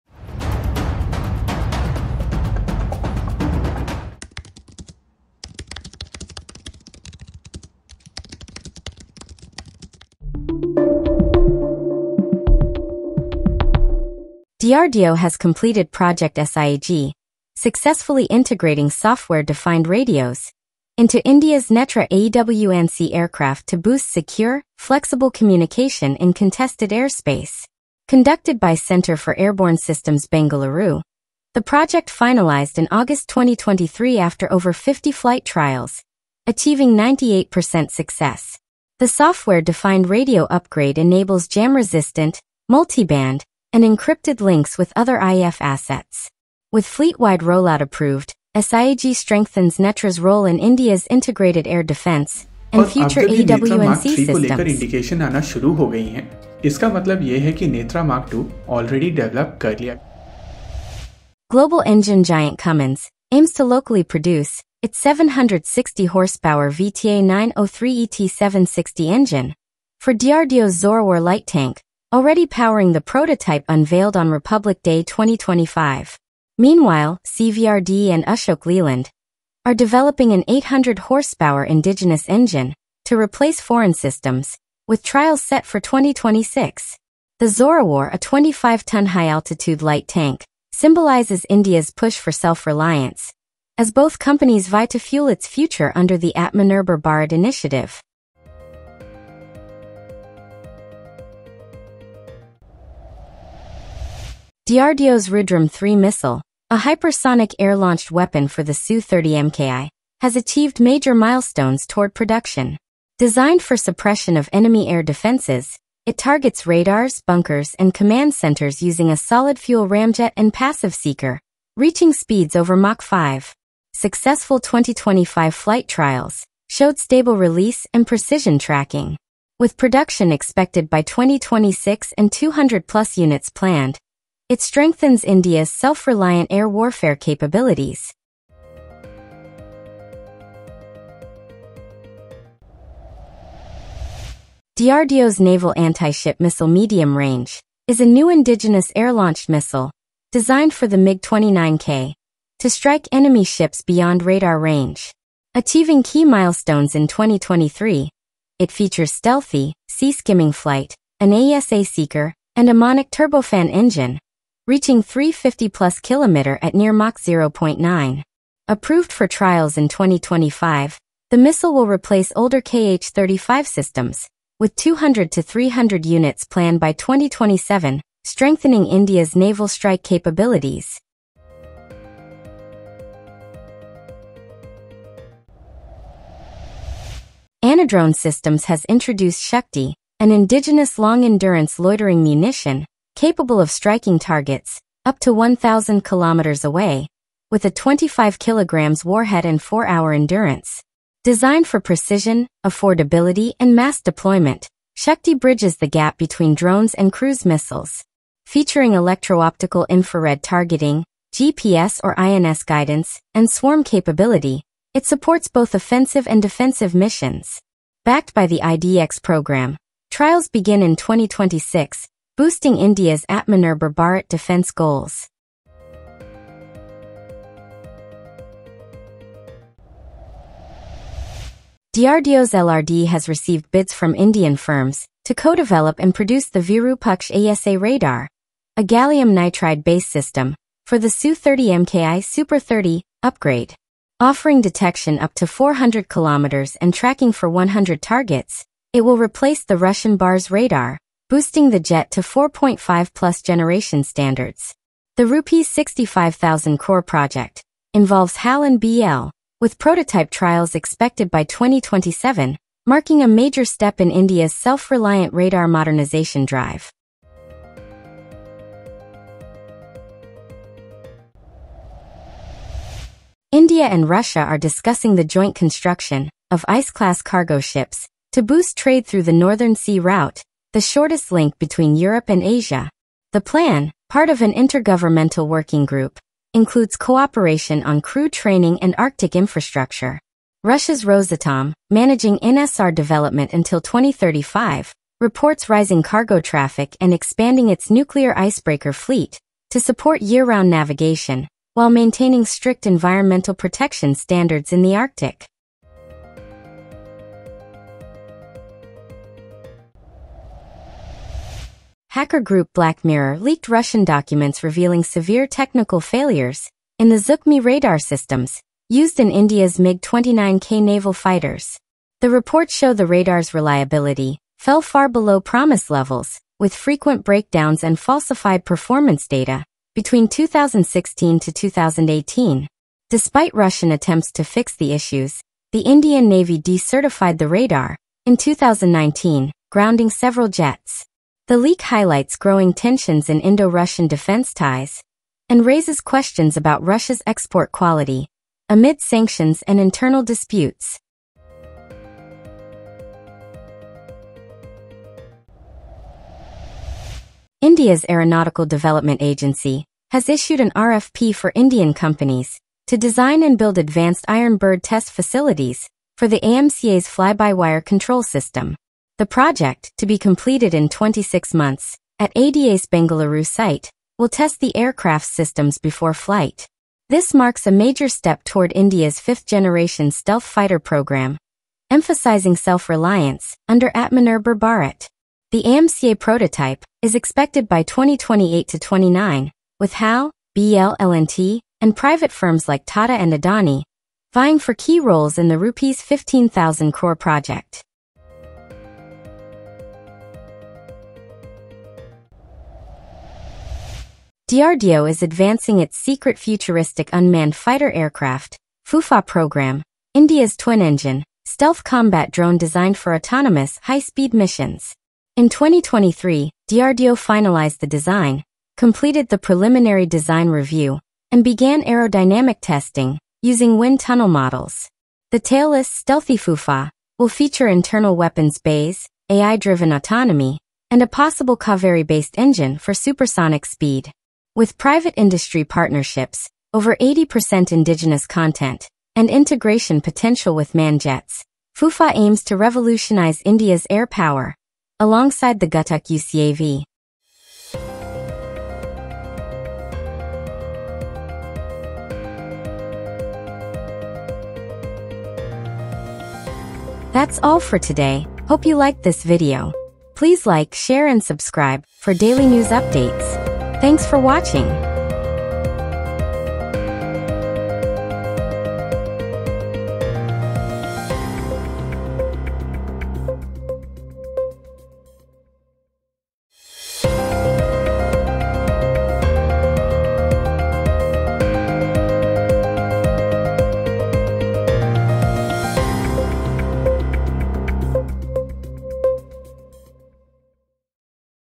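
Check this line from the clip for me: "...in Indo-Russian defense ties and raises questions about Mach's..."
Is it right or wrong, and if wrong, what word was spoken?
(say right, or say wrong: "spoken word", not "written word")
wrong: "Russia", not "Mach".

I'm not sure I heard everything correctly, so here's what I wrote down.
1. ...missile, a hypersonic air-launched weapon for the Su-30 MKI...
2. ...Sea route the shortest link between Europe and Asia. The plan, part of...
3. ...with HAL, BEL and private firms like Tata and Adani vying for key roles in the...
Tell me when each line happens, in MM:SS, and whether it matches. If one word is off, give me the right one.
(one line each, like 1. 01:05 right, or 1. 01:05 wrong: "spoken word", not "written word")
1. 01:45 right
2. 04:39 right
3. 06:29 right.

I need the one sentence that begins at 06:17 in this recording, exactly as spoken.
This marks a major step toward India's fifth-generation stealth fighter program, emphasizing self-reliance under Atmanirbhar Bharat.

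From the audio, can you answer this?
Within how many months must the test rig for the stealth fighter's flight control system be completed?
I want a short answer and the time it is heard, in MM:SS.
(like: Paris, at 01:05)
26, at 06:10.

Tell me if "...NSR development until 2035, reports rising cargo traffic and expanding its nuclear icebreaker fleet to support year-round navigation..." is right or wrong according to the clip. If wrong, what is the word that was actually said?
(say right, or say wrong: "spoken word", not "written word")
right.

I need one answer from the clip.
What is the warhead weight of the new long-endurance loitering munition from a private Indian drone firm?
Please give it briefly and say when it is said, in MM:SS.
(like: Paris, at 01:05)
25 kilograms, at 03:17.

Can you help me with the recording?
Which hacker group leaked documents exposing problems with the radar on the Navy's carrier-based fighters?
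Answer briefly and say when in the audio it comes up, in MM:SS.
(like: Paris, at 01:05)
Black Mirror, at 05:12.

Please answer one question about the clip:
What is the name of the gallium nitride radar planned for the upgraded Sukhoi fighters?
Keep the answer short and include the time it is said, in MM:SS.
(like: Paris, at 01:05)
Virupaksha, at 03:56.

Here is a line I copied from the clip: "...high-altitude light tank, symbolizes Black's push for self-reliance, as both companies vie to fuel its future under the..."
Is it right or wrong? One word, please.
wrong.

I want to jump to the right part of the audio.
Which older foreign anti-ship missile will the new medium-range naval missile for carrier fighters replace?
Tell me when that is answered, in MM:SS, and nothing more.
02:52.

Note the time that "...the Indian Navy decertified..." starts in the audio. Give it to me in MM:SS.
05:35.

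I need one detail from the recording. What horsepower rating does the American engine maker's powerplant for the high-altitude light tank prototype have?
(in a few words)
760.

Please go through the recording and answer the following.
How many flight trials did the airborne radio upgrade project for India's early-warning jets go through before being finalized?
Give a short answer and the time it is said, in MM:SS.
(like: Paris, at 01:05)
over 50, at 00:34.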